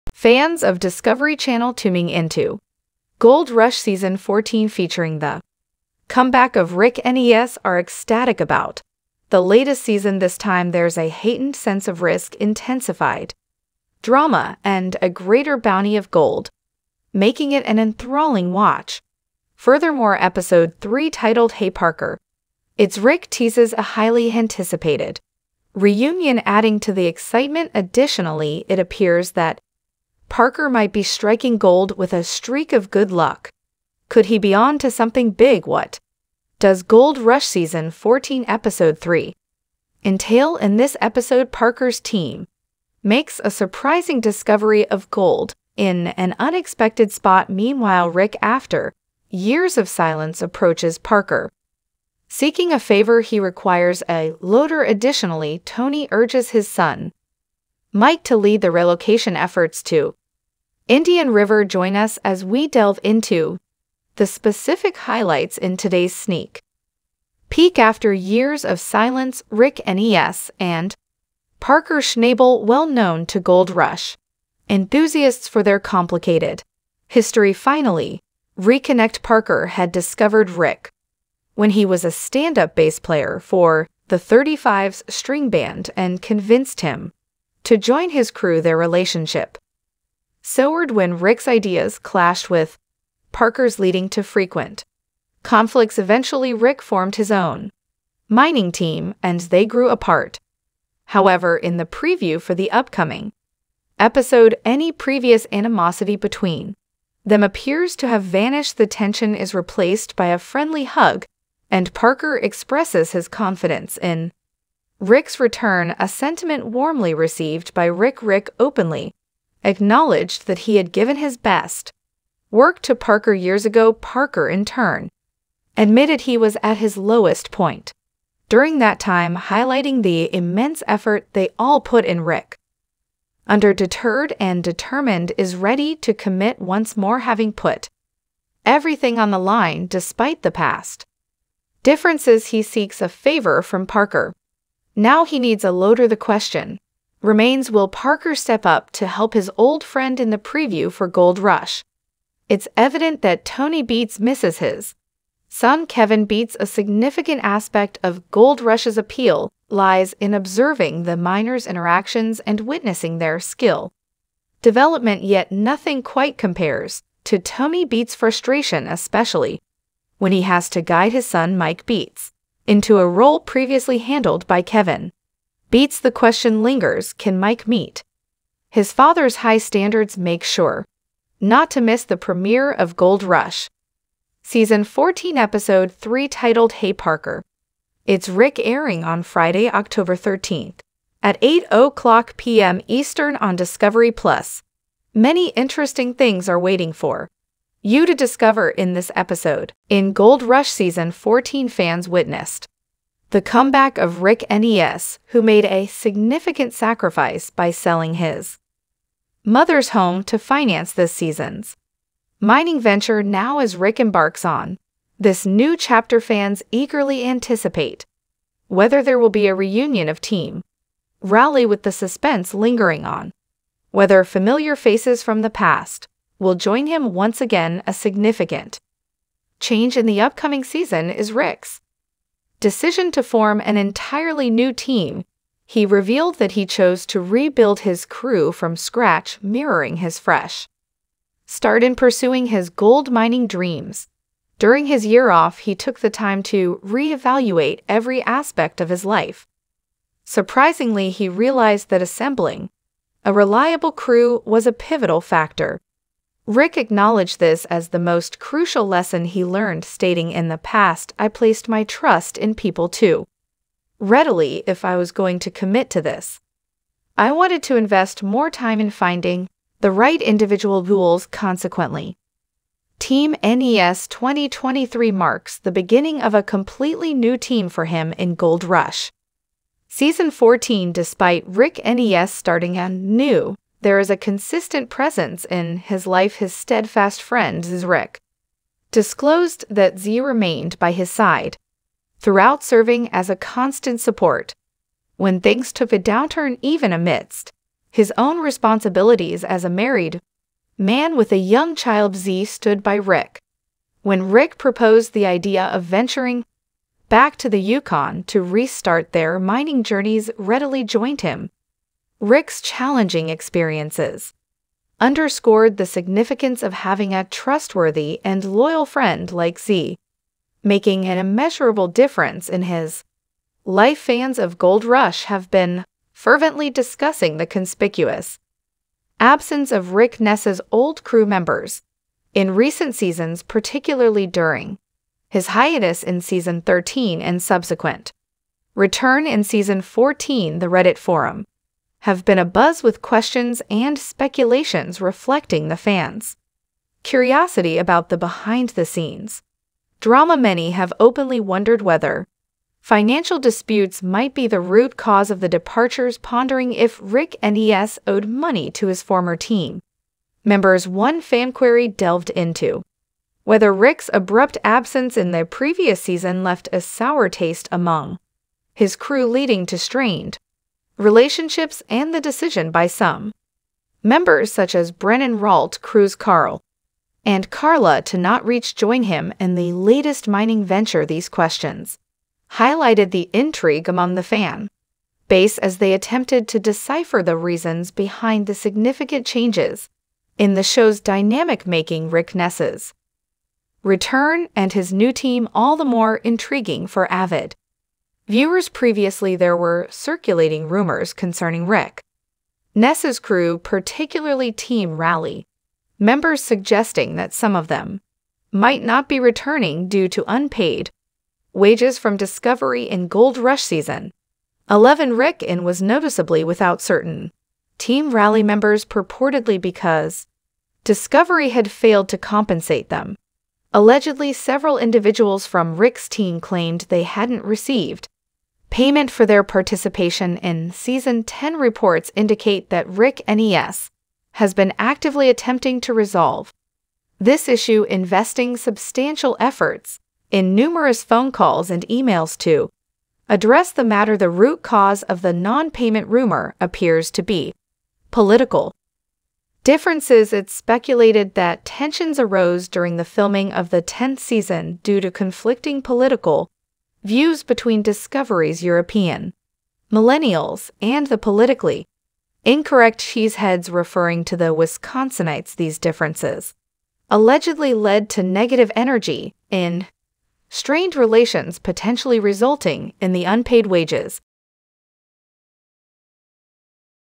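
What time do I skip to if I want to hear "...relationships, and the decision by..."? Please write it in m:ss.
6:10.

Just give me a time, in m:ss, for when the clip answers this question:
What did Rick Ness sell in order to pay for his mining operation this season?
3:29.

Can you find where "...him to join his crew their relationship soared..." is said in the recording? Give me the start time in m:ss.
1:26.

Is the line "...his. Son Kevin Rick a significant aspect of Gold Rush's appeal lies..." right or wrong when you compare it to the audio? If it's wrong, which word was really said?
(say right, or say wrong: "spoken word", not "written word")
wrong: "Beets", not "Rick".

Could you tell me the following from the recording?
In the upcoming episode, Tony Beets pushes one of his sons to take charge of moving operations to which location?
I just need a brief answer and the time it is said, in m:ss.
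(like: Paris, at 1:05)
Indian River, at 1:00.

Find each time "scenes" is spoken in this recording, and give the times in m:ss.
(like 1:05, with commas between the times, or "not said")
5:48.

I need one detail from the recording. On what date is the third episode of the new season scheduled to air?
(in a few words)
Friday, October 13th.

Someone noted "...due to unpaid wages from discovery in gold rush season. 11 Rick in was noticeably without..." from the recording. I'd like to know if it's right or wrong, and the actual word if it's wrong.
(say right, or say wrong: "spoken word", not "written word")
right.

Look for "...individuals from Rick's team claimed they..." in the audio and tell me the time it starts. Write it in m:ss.
7:04.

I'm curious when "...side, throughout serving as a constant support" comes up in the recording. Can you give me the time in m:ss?
4:51.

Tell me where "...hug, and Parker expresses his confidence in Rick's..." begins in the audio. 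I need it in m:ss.
1:50.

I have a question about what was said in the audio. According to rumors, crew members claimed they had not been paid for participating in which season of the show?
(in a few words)
Season 10.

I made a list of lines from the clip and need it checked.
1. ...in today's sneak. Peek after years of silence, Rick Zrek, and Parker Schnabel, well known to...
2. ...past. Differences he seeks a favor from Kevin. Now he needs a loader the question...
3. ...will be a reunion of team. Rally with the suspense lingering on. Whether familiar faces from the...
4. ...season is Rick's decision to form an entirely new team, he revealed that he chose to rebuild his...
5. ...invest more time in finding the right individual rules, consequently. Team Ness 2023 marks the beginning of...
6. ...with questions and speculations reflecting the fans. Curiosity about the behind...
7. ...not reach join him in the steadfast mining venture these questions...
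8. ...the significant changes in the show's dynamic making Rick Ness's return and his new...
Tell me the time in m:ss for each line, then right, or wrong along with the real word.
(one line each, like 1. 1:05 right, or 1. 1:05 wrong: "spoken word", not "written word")
1. 1:05 wrong: "Ness", not "Zrek"
2. 2:20 wrong: "Parker", not "Kevin"
3. 3:39 right
4. 3:50 right
5. 4:27 right
6. 5:42 right
7. 6:18 wrong: "latest", not "steadfast"
8. 6:28 right.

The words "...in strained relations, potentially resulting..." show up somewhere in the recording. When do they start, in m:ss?
7:49.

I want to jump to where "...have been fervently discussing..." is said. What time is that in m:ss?
5:25.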